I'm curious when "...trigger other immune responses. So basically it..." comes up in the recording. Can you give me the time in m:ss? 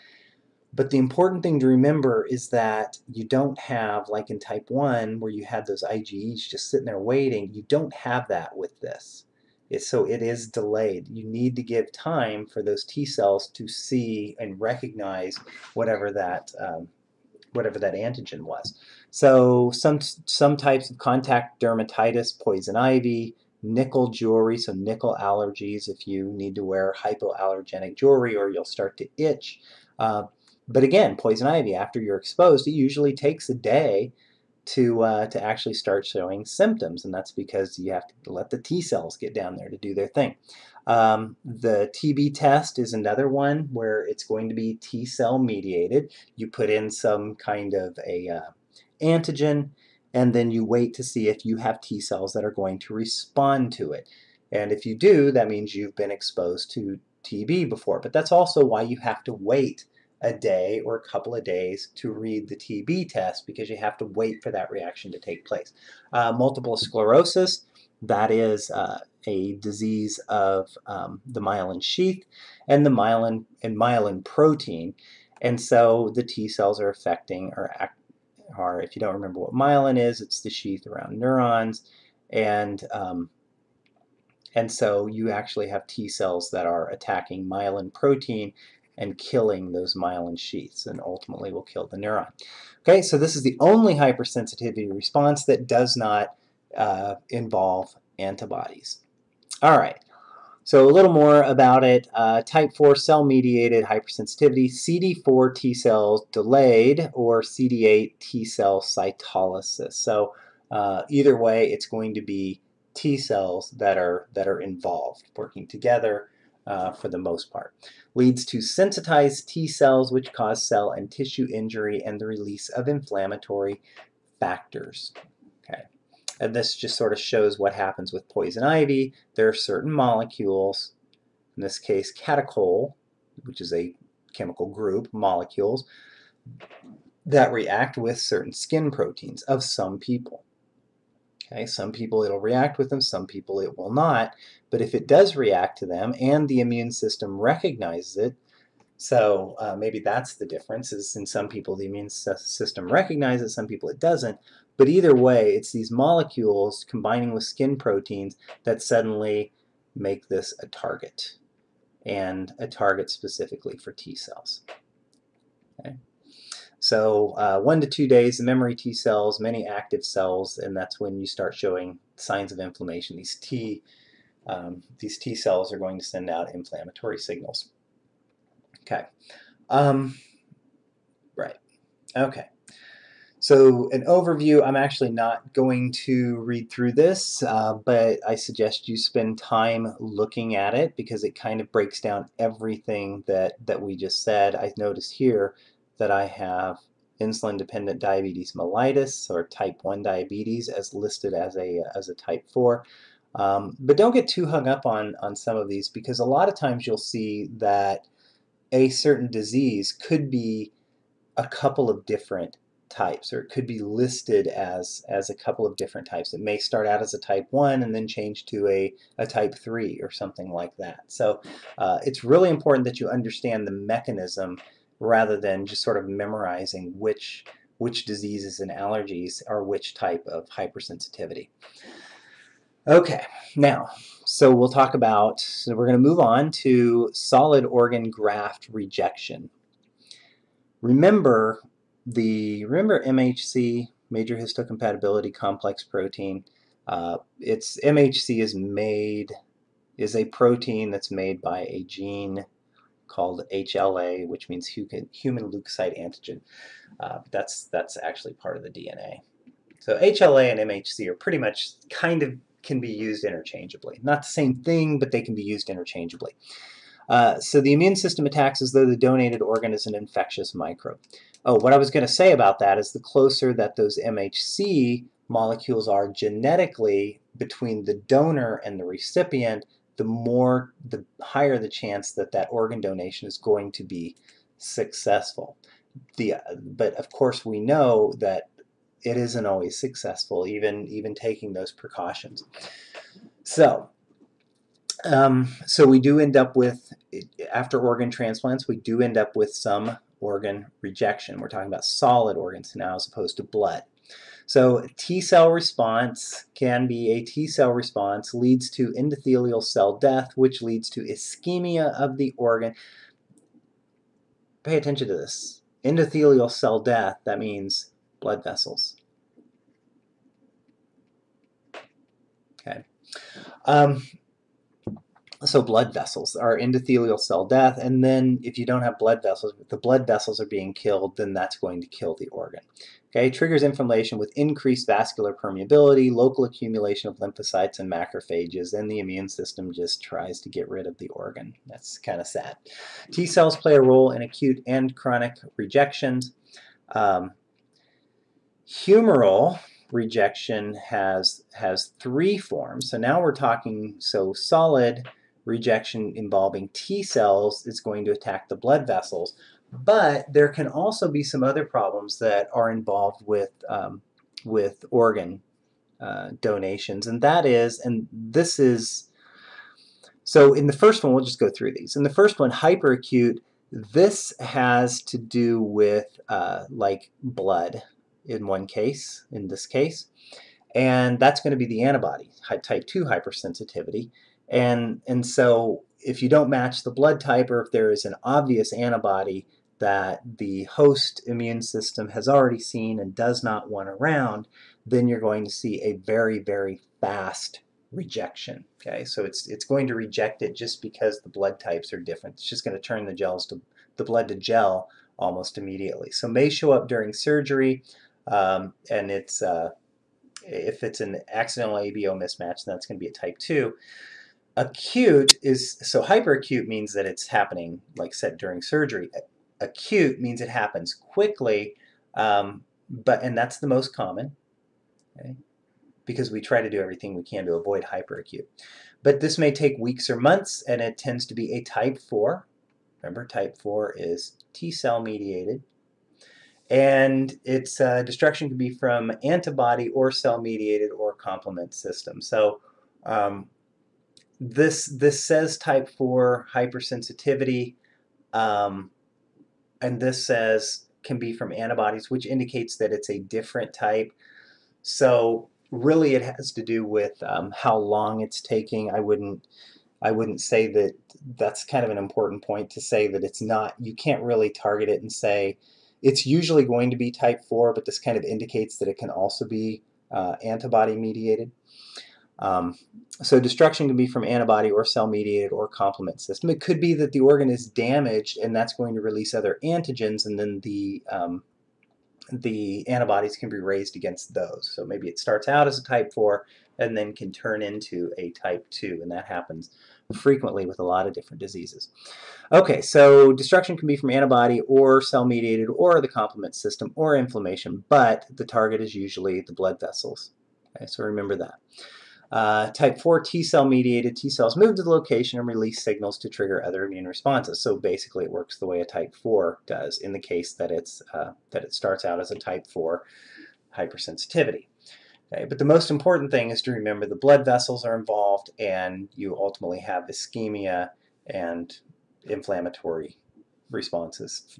8:26.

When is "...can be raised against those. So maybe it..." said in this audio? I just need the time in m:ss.
8:03.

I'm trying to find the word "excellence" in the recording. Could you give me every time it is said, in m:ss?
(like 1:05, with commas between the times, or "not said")
not said.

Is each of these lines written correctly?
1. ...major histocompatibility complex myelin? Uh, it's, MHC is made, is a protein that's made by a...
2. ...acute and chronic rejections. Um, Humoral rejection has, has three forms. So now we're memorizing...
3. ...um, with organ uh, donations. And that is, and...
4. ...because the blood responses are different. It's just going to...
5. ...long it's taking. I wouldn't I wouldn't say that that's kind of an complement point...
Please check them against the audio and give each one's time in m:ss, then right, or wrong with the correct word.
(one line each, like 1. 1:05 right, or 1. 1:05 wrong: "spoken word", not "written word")
1. 4:04 wrong: "protein", not "myelin"
2. 5:44 wrong: "talking", not "memorizing"
3. 6:03 right
4. 6:40 wrong: "types", not "responses"
5. 7:37 wrong: "important", not "complement".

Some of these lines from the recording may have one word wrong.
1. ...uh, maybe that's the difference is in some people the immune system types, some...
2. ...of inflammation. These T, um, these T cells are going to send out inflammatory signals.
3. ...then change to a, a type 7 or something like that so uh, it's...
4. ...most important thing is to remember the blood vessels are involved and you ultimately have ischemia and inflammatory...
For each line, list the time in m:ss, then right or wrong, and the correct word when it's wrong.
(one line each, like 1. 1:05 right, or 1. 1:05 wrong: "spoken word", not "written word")
1. 2:29 wrong: "recognizes", not "types"
2. 2:52 right
3. 3:37 wrong: "3", not "7"
4. 8:35 right.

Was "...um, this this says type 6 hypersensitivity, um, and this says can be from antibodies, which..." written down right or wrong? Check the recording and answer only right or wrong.
wrong.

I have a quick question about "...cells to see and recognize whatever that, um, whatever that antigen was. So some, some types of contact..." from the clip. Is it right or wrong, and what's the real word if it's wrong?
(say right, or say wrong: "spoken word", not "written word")
right.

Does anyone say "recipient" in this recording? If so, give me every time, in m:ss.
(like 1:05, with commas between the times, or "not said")
4:38.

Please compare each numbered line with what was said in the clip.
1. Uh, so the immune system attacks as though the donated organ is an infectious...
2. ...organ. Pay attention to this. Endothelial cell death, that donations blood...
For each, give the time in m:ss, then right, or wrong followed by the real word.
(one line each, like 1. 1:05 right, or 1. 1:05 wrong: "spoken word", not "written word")
1. 4:27 right
2. 5:12 wrong: "means", not "donations".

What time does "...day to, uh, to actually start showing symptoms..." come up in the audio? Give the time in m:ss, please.
0:33.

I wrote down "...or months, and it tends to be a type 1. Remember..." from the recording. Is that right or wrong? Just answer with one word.
wrong.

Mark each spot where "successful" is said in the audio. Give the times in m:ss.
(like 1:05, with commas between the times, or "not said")
4:44, 4:49.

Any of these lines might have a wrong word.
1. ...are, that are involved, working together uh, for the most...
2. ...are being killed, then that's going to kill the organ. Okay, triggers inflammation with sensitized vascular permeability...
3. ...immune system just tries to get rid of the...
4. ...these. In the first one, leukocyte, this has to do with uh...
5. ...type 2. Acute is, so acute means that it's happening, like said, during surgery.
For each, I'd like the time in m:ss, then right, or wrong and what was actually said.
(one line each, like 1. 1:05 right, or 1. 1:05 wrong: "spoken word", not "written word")
1. 1:53 right
2. 5:30 wrong: "increased", not "sensitized"
3. 5:38 right
4. 6:11 wrong: "hyperacute", not "leukocyte"
5. 6:53 wrong: "hyperacute", not "acute".